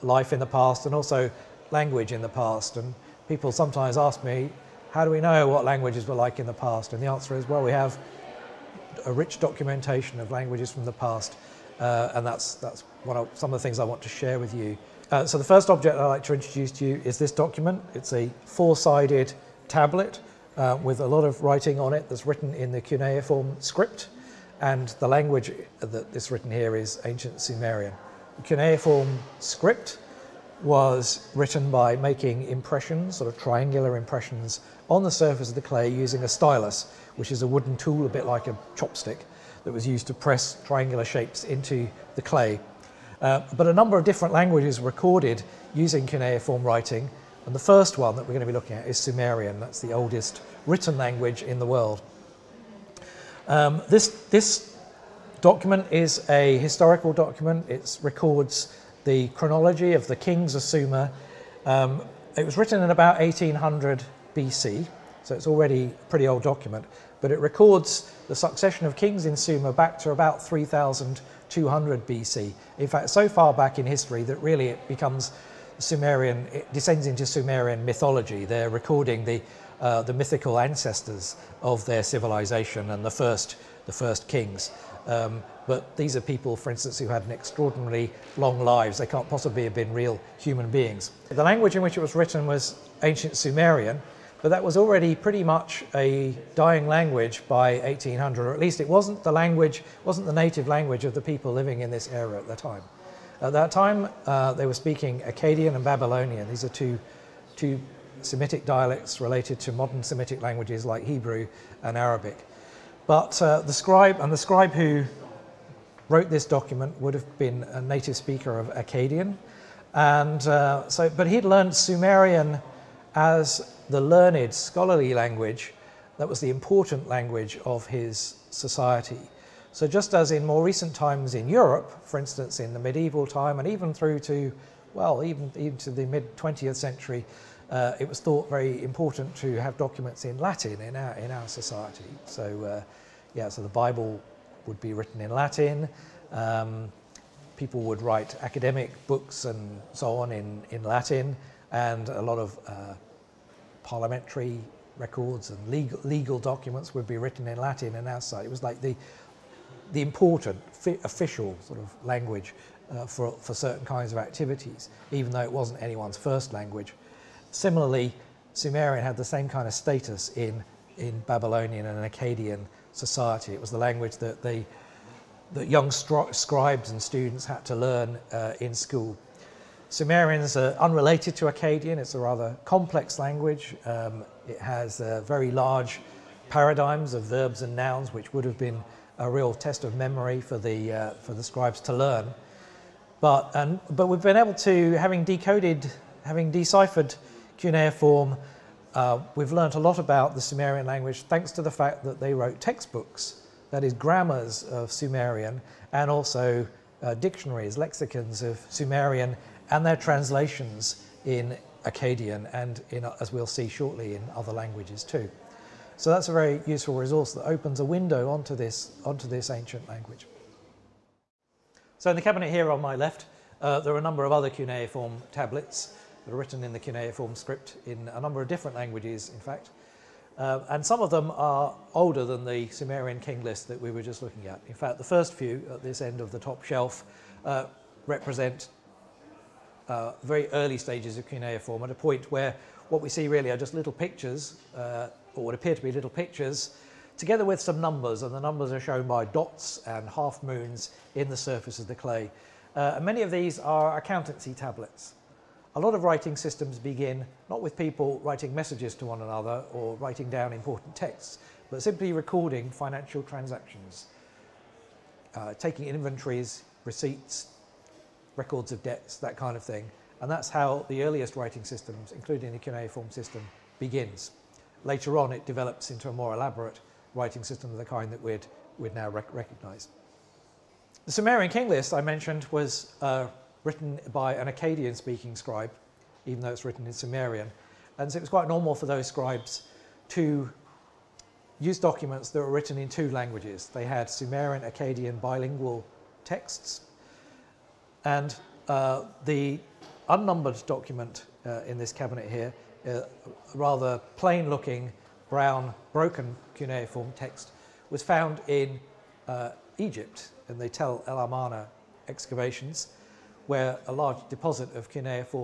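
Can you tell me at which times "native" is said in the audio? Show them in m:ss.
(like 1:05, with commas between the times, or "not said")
1:40, 1:57.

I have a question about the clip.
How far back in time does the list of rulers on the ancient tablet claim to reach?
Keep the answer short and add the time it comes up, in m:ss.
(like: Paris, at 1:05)
3200 BC, at 1:10.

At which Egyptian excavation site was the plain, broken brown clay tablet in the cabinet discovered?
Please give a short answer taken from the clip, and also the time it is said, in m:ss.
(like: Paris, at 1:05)
Tel El Amarna, at 5:10.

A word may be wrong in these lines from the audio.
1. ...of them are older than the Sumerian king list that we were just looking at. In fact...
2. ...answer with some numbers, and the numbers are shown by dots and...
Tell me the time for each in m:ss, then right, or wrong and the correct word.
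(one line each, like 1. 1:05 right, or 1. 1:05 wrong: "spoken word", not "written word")
1. 3:51 right
2. 4:07 wrong: "together", not "answer".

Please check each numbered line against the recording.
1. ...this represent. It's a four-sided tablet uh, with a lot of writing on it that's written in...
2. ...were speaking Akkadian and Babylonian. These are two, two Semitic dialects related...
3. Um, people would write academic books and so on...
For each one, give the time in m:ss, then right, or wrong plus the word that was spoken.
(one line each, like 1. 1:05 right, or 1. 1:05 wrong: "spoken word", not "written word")
1. 0:17 wrong: "document", not "represent"
2. 1:44 right
3. 2:26 right.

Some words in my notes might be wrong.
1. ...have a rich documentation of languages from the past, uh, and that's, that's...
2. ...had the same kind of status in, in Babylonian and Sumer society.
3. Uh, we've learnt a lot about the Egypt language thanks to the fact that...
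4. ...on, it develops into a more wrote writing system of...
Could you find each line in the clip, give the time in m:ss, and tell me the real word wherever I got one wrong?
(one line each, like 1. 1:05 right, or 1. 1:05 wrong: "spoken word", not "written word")
1. 0:07 right
2. 2:49 wrong: "Akkadian", not "Sumer"
3. 3:18 wrong: "Sumerian", not "Egypt"
4. 4:35 wrong: "elaborate", not "wrote".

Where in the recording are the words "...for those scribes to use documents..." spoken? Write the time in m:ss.
4:48.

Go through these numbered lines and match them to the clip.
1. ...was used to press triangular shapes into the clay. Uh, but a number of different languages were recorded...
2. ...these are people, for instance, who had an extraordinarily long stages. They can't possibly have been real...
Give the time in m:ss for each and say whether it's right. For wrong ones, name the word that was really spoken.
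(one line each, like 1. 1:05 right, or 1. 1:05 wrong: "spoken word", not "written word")
1. 0:39 right
2. 1:25 wrong: "lives", not "stages".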